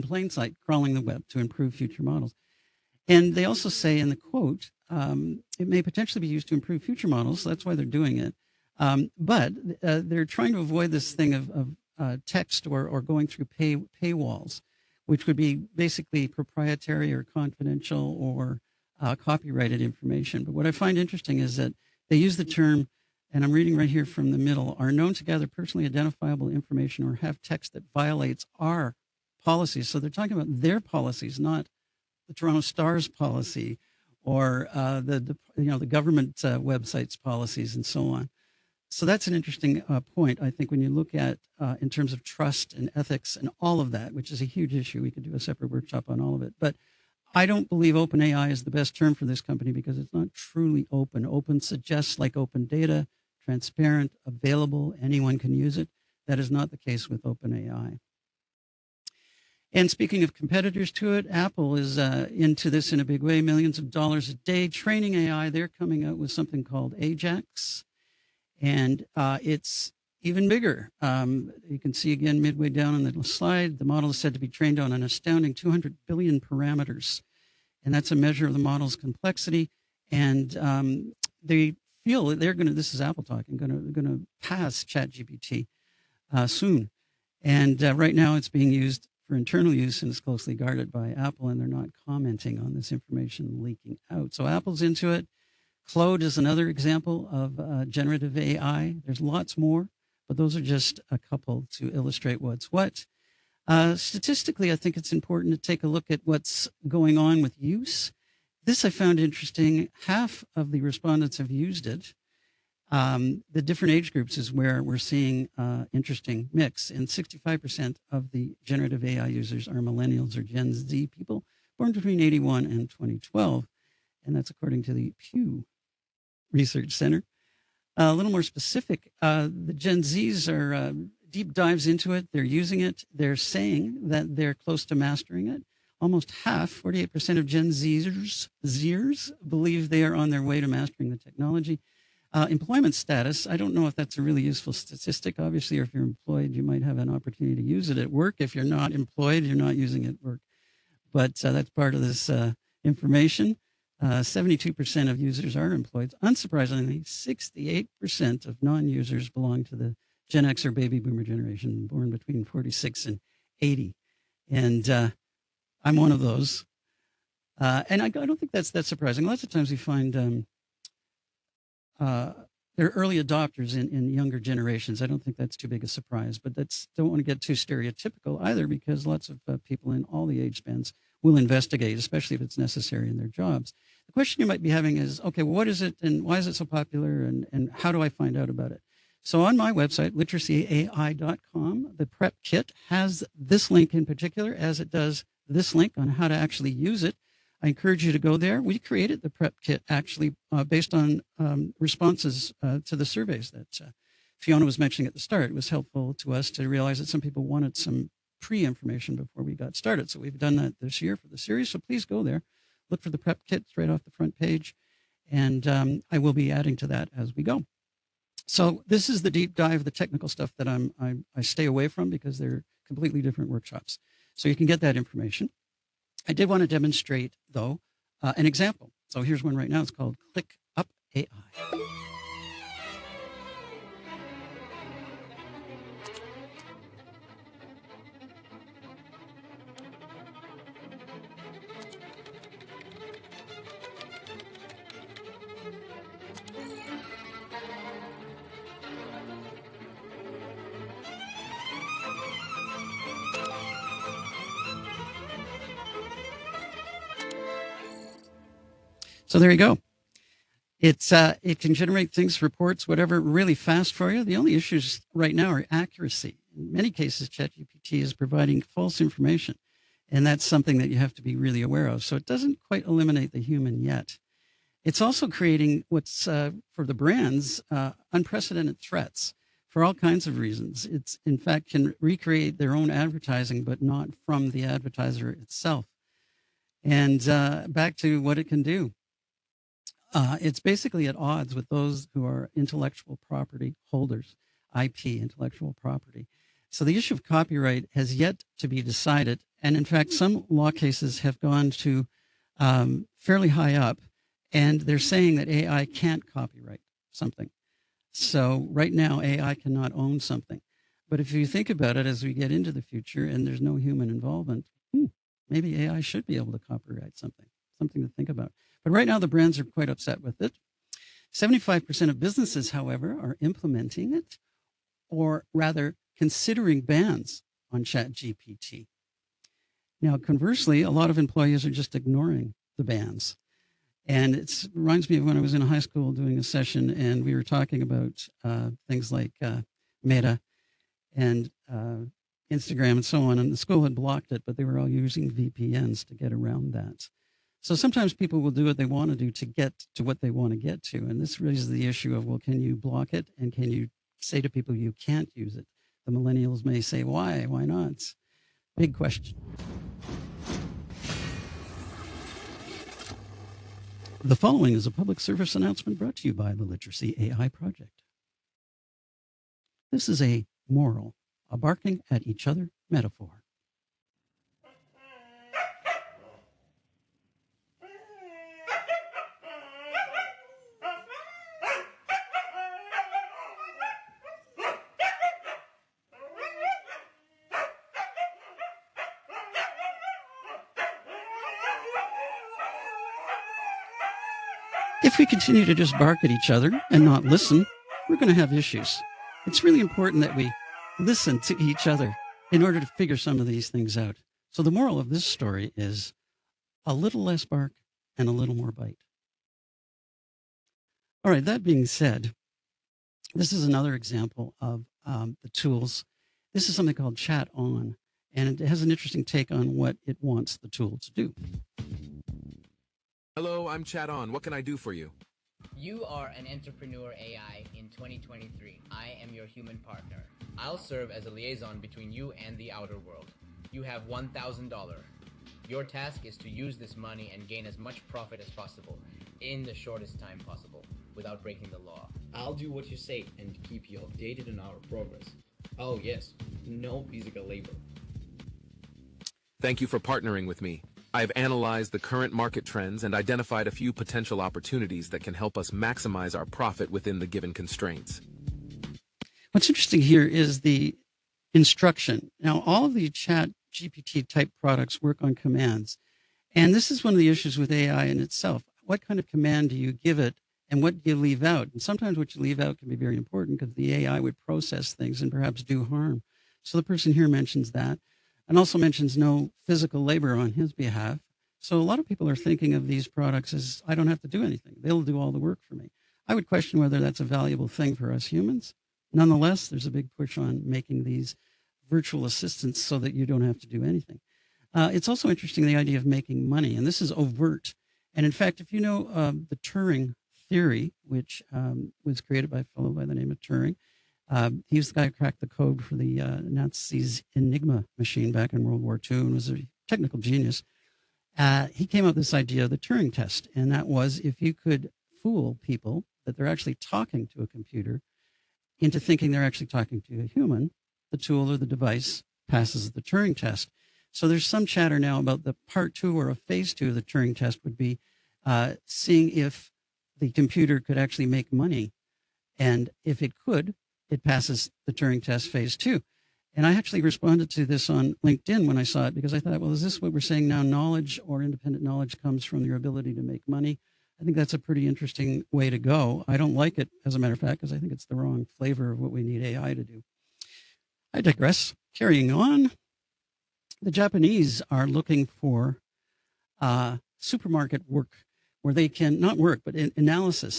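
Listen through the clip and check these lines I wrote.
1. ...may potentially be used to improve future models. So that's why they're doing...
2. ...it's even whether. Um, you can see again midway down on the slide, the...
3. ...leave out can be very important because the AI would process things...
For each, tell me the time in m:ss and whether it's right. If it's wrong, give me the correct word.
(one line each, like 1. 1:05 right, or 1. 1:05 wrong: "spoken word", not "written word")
1. 0:05 right
2. 1:09 wrong: "bigger", not "whether"
3. 7:52 right.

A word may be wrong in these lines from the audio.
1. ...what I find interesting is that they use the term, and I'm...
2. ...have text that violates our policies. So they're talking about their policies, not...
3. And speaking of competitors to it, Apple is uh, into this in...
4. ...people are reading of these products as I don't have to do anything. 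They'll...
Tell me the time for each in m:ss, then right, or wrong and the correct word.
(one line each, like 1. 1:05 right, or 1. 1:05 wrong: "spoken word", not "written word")
1. 0:20 right
2. 0:27 right
3. 0:59 right
4. 8:02 wrong: "thinking", not "reading".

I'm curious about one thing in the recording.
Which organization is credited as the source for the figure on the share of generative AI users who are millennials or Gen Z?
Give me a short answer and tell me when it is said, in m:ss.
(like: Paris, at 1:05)
Pew Research Center, at 2:05.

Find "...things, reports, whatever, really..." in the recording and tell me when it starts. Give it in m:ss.
4:22.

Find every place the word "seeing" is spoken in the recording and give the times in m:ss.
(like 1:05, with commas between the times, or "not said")
1:54, 8:48.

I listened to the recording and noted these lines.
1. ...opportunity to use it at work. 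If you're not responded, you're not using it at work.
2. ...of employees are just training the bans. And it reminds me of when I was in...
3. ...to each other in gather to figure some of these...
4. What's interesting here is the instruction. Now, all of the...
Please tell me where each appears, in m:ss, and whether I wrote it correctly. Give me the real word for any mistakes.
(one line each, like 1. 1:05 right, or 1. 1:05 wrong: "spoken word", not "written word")
1. 2:27 wrong: "employed", not "responded"
2. 5:31 wrong: "ignoring", not "training"
3. 6:41 wrong: "order", not "gather"
4. 7:39 right.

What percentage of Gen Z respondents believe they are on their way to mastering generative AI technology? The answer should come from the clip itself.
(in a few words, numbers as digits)
48%.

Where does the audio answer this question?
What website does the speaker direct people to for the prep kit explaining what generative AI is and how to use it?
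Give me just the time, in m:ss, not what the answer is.
3:10.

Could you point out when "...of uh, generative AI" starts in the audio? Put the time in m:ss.
1:37.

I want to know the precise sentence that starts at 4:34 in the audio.
It's also creating what's uh, for the brands uh, unprecedented threats for all kinds of reasons.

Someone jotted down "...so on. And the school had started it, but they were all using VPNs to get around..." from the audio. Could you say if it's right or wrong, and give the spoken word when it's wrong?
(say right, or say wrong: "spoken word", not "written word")
wrong: "blocked", not "started".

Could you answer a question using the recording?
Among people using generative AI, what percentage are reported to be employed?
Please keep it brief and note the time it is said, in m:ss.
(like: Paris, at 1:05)
72%, at 2:34.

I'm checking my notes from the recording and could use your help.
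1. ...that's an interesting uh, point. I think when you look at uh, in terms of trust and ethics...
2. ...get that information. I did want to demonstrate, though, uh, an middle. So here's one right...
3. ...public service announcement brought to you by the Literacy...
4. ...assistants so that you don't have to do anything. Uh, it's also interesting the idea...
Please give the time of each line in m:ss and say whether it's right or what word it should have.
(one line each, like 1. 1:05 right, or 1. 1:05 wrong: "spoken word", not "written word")
1. 0:39 right
2. 3:44 wrong: "example", not "middle"
3. 6:04 right
4. 8:12 right.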